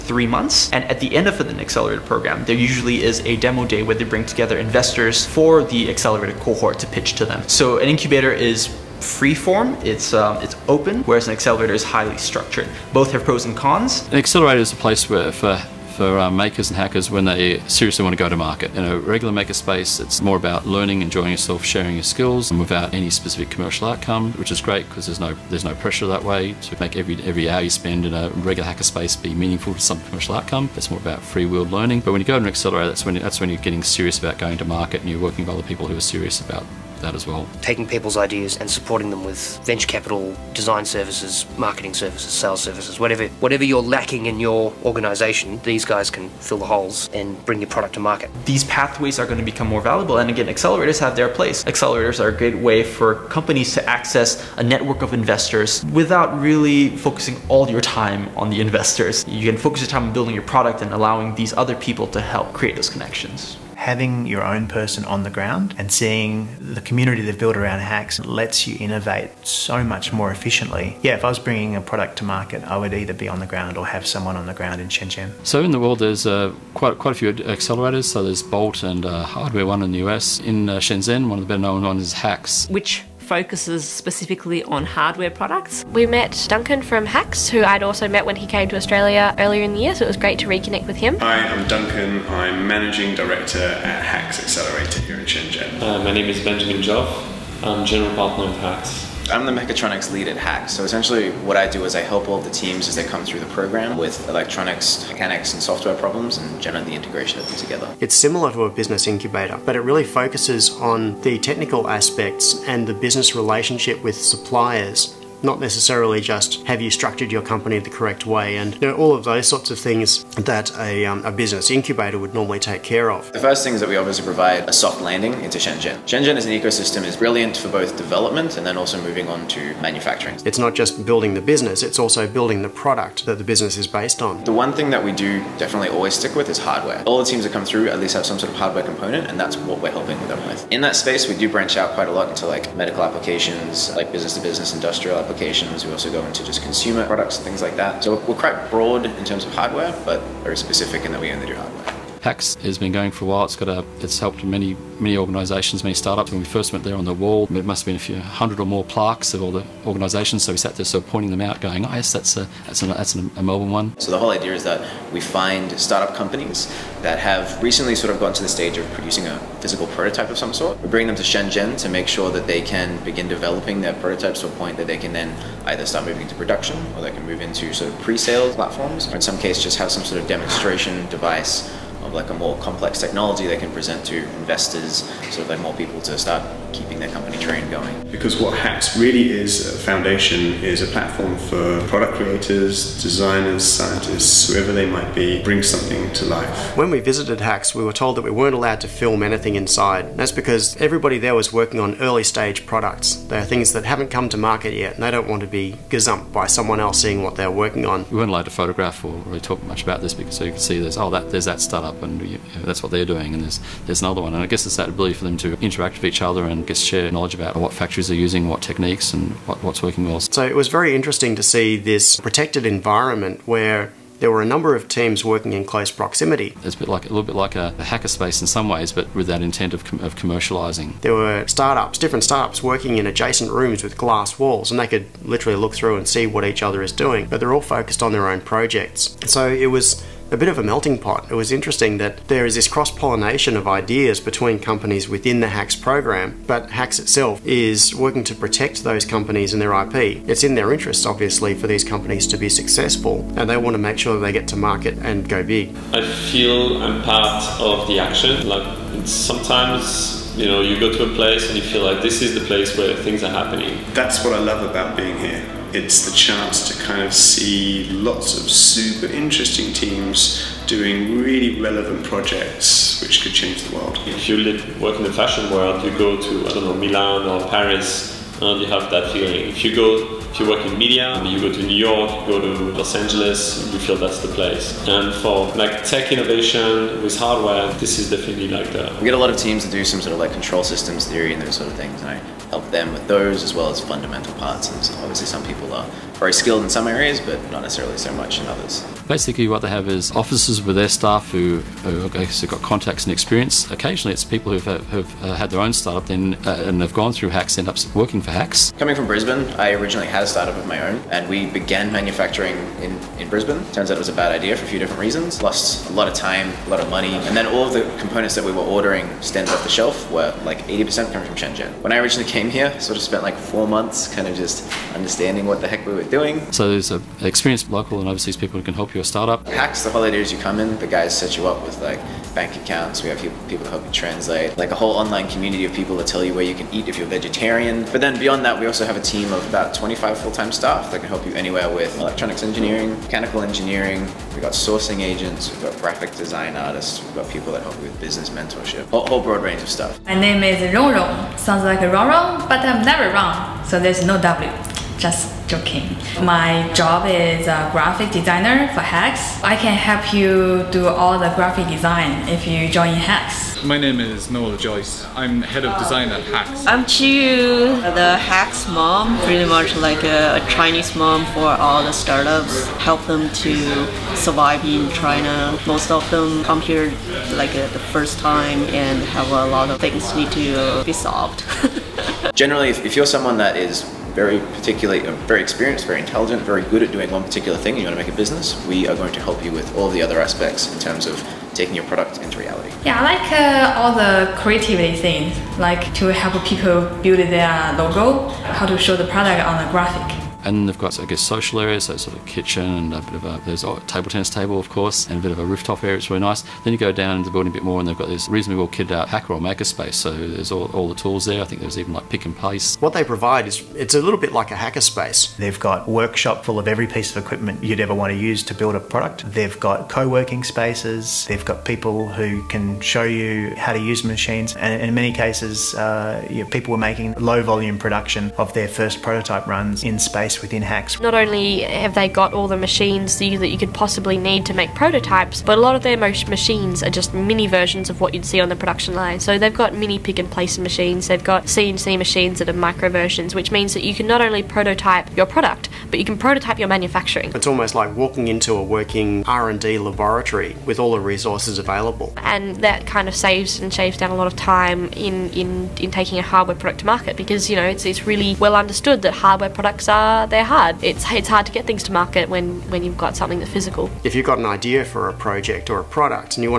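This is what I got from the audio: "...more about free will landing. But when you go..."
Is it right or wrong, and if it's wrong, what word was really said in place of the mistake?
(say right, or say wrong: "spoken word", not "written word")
wrong: "learning", not "landing".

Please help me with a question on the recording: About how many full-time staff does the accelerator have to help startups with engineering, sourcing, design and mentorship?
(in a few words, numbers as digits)
25.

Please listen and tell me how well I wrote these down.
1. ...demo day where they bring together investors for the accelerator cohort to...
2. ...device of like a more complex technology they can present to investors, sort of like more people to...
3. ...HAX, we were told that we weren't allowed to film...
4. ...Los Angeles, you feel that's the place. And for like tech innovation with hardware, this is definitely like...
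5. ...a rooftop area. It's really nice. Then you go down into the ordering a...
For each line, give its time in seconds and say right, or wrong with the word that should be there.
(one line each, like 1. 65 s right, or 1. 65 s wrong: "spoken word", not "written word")
1. 3 s right
2. 181 s right
3. 197 s right
4. 282 s right
5. 405 s wrong: "building", not "ordering".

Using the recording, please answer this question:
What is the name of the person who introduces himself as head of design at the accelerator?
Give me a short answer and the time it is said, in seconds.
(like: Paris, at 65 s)
Noel Joyce, at 364 s.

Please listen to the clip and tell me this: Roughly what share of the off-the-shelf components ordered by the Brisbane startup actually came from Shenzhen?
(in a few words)
80%.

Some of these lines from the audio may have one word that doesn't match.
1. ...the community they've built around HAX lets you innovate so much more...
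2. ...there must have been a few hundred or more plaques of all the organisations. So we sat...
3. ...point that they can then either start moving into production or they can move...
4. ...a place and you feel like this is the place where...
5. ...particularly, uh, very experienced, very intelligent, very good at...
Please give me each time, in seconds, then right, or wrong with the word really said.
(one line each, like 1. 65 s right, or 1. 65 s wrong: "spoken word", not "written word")
1. 66 s right
2. 157 s right
3. 174 s right
4. 261 s right
5. 384 s right.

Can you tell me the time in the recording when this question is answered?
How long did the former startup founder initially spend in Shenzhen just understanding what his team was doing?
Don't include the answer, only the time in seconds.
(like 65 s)
323 s.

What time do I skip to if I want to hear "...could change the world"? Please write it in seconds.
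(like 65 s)
273 s.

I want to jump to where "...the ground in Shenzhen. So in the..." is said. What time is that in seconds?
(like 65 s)
74 s.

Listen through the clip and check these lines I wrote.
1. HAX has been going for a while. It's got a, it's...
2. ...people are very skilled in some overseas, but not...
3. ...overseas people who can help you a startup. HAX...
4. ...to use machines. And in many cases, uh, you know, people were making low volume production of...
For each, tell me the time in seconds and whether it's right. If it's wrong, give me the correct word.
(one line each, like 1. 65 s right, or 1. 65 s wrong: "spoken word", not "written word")
1. 152 s right
2. 295 s wrong: "areas", not "overseas"
3. 328 s right
4. 423 s right.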